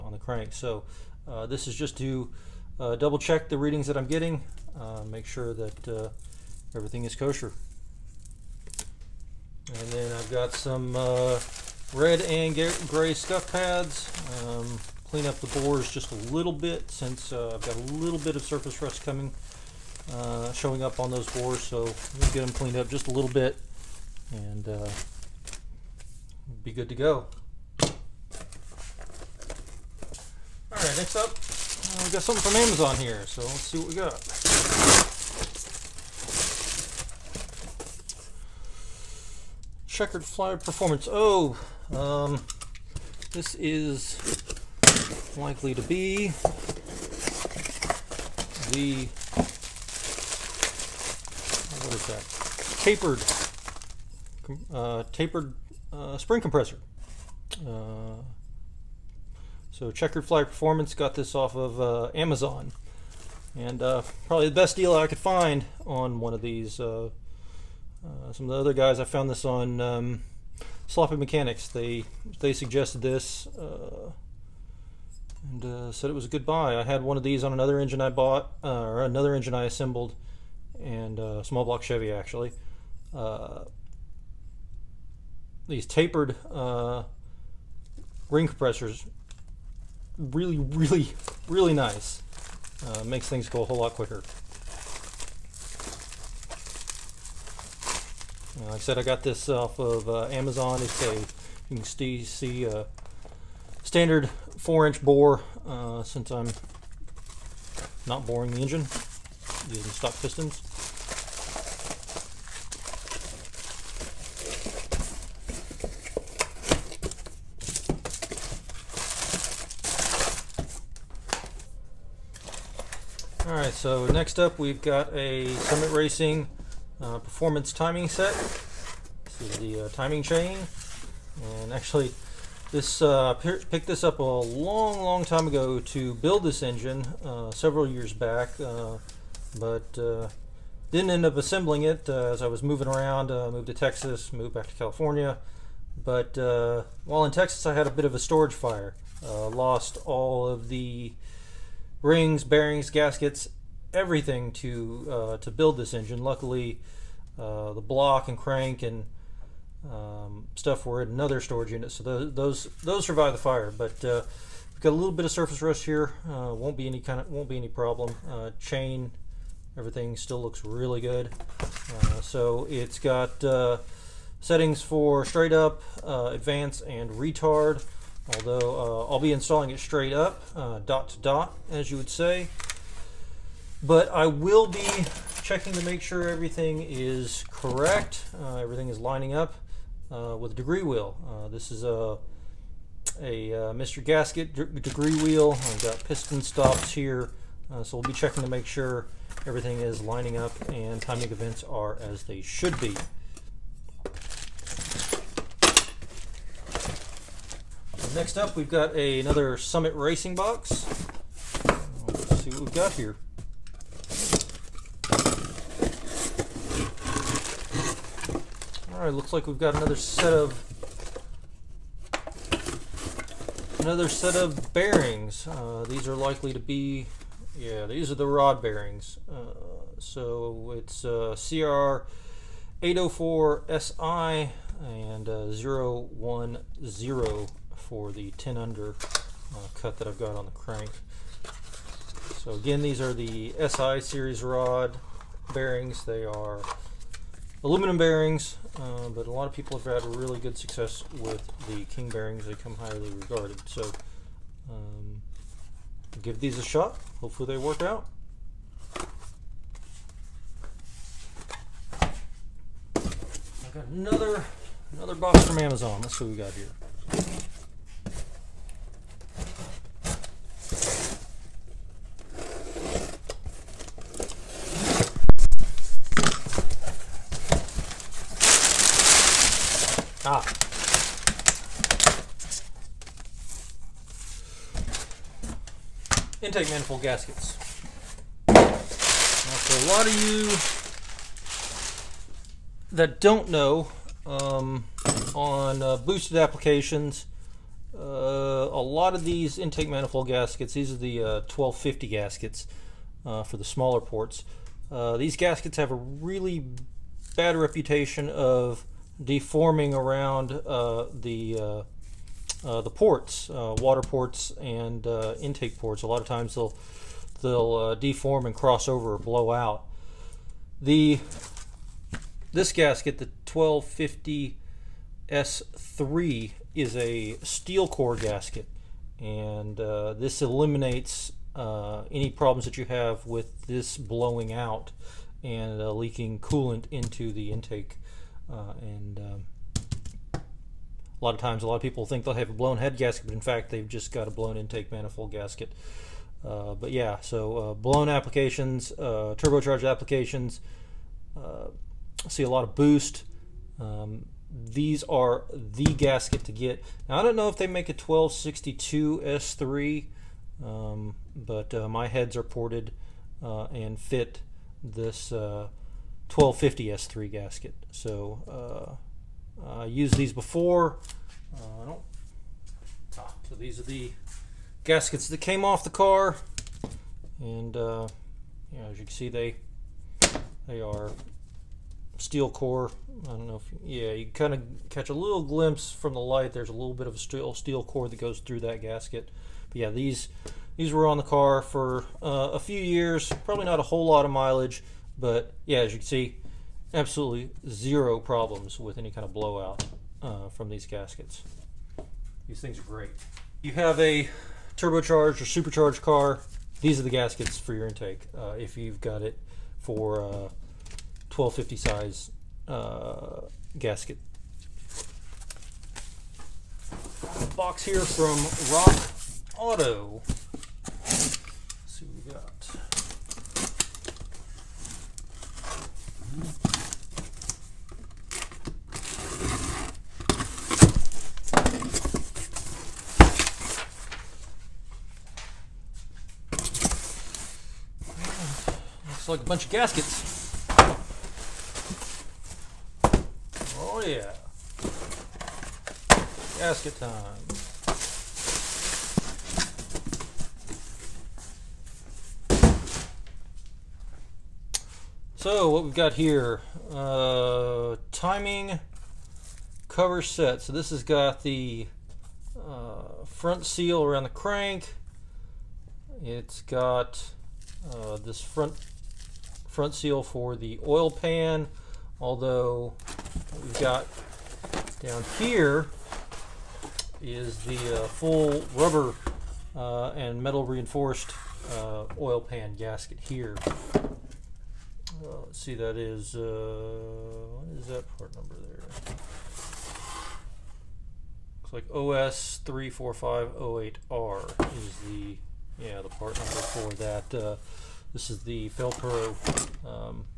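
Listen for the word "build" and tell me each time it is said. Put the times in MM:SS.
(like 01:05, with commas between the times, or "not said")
02:16, 02:35.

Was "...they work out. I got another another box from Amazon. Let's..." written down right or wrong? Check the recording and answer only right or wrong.
right.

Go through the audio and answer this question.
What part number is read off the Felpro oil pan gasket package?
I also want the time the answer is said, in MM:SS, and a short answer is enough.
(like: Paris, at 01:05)
OS34508R, at 08:11.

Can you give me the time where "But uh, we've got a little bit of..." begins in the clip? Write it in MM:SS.
02:43.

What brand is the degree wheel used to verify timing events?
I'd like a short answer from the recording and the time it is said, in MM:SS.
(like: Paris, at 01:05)
Mr. Gasket, at 03:13.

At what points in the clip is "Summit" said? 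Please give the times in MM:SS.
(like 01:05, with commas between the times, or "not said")
02:05, 03:29.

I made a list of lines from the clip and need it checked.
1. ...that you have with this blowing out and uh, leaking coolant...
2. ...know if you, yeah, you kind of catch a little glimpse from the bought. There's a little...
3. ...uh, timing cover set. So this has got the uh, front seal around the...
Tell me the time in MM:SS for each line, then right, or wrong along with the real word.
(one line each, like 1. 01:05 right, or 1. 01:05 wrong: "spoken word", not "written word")
1. 05:32 right
2. 06:23 wrong: "light", not "bought"
3. 07:36 right.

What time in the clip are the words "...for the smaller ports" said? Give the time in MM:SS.
05:03.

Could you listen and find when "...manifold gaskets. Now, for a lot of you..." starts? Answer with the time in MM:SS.
04:46.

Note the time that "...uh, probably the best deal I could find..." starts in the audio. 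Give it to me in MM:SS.
01:03.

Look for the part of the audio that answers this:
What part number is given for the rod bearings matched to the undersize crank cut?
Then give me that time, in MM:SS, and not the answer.
03:51.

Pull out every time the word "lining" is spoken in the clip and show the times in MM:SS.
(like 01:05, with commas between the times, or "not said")
03:08, 03:19.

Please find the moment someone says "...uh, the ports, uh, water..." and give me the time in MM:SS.
05:12.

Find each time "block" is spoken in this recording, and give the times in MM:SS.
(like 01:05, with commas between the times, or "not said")
01:21, 02:37.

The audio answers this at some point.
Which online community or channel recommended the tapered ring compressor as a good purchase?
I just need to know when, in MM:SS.
01:10.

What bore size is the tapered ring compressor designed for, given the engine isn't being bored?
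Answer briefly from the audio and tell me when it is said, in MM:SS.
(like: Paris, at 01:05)
4-inch, at 01:44.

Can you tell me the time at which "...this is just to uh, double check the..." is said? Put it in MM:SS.
00:01.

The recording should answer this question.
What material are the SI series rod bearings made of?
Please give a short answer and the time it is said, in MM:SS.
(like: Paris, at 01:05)
aluminum, at 04:07.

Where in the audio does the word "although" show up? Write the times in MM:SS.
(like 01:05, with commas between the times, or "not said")
02:58, 07:52.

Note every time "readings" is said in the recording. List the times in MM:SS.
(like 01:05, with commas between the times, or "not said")
00:03.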